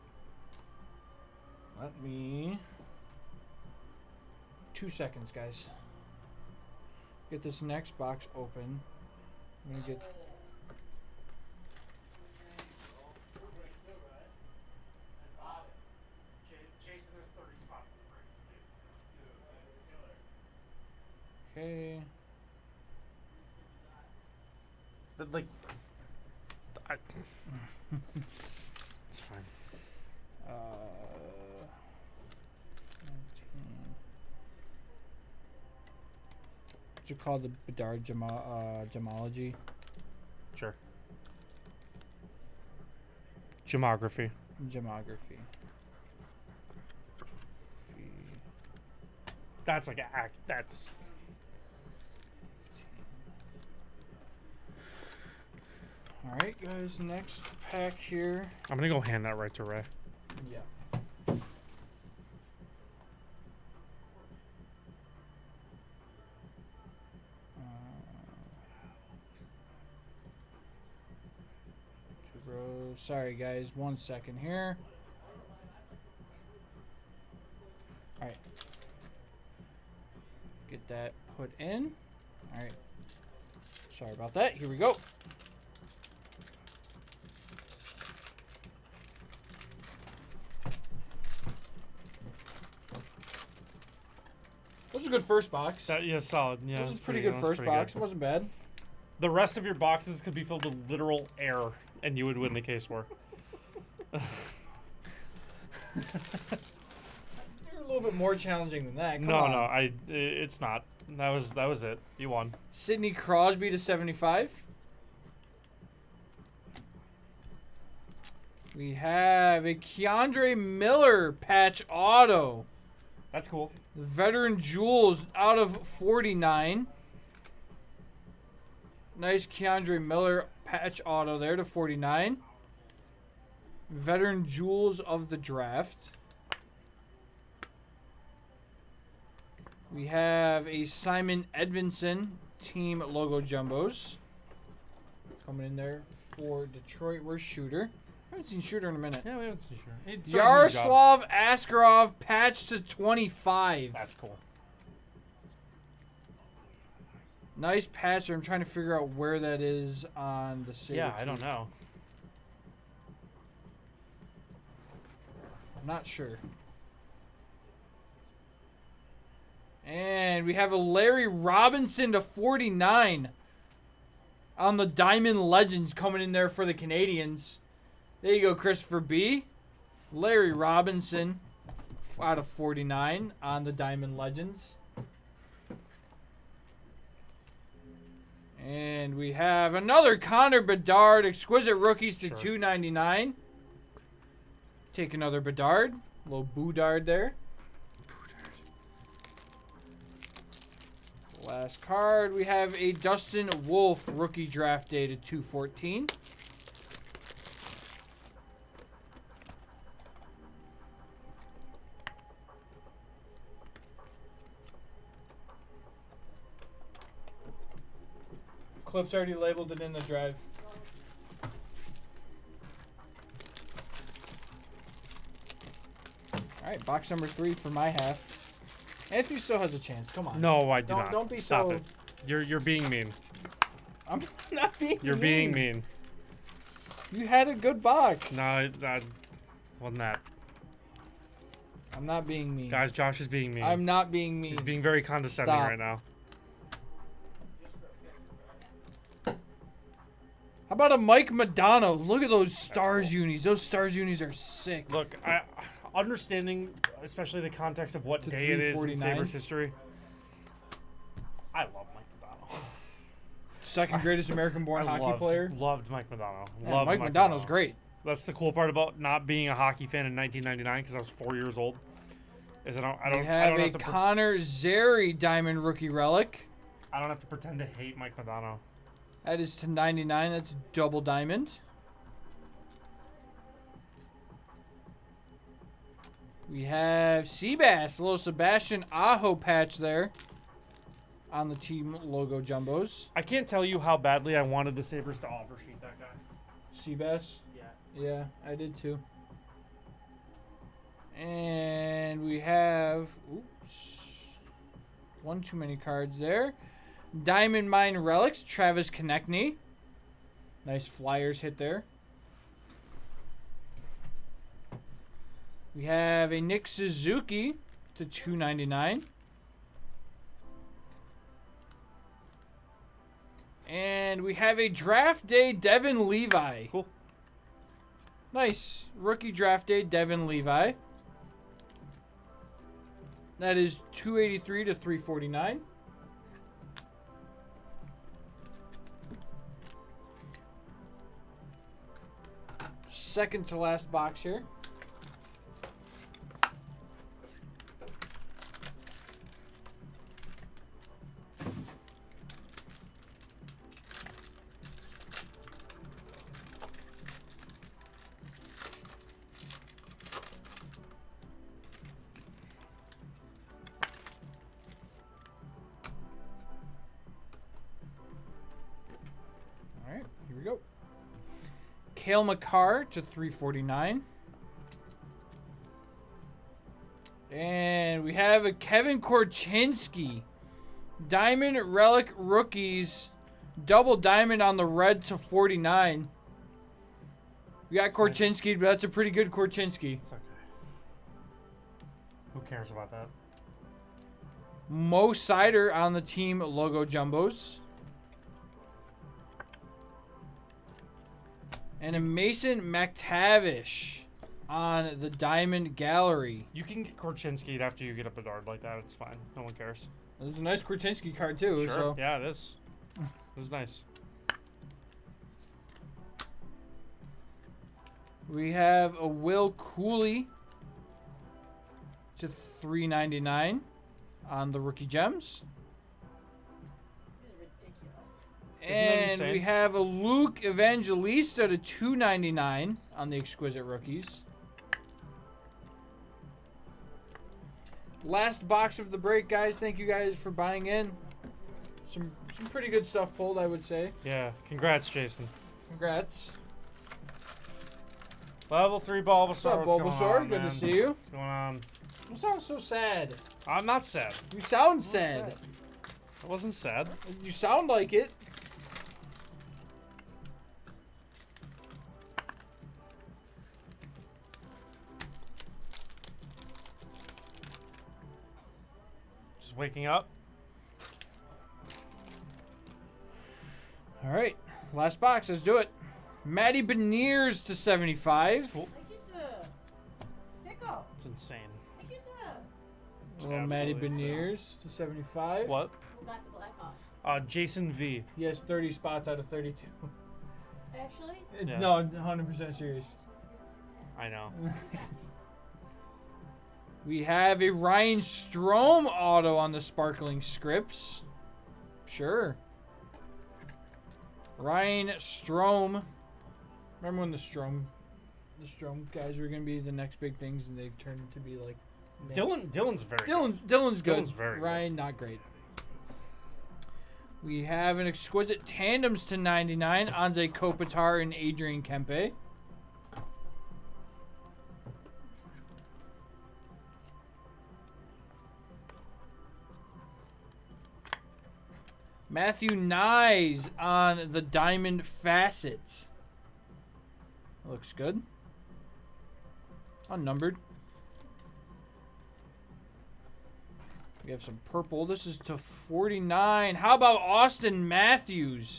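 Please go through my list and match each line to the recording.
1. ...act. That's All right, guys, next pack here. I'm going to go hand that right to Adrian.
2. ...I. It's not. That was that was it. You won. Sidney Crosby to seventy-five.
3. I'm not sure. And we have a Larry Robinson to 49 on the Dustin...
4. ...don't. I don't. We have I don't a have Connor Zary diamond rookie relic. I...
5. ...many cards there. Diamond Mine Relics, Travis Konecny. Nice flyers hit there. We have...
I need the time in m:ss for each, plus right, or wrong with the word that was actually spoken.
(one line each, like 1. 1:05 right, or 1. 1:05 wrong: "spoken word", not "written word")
1. 0:50 wrong: "Ray", not "Adrian"
2. 1:49 right
3. 2:45 wrong: "Diamond", not "Dustin"
4. 4:32 right
5. 5:05 right.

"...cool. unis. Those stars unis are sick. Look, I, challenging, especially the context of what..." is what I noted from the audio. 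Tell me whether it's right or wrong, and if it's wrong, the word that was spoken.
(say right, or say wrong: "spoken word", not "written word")
wrong: "understanding", not "challenging".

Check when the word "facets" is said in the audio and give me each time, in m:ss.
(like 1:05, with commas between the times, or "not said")
8:54.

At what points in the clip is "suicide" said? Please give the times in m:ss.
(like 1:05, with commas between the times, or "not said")
not said.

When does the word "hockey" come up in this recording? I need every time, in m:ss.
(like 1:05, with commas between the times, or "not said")
4:24, 4:29.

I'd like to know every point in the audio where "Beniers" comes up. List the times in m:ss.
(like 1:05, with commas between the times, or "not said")
7:56, 8:03.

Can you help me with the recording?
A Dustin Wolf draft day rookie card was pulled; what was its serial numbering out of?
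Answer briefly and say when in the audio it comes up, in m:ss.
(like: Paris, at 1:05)
214, at 3:25.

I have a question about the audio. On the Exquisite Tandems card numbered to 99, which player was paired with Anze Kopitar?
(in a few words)
Adrian Kempe.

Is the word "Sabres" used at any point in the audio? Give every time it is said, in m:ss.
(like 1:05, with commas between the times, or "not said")
4:18, 4:54.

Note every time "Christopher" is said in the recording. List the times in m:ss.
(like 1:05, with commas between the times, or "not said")
2:58.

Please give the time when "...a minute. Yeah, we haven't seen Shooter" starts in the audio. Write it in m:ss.
2:28.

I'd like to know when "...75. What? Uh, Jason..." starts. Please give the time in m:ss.
8:04.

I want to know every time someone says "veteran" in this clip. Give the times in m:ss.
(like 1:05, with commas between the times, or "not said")
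2:04, 2:13.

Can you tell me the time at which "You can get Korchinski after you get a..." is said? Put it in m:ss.
6:46.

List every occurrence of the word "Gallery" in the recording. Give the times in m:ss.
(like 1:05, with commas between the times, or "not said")
6:45.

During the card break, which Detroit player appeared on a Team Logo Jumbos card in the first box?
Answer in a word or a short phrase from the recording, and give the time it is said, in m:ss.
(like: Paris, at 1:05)
Simon Edvinsson, at 2:20.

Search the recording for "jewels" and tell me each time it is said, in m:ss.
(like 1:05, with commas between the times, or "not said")
2:04, 2:14.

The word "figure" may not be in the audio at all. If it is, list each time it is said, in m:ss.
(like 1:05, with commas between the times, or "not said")
2:38.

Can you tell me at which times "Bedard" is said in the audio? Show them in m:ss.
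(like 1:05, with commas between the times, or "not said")
0:37, 3:10, 3:15, 6:48.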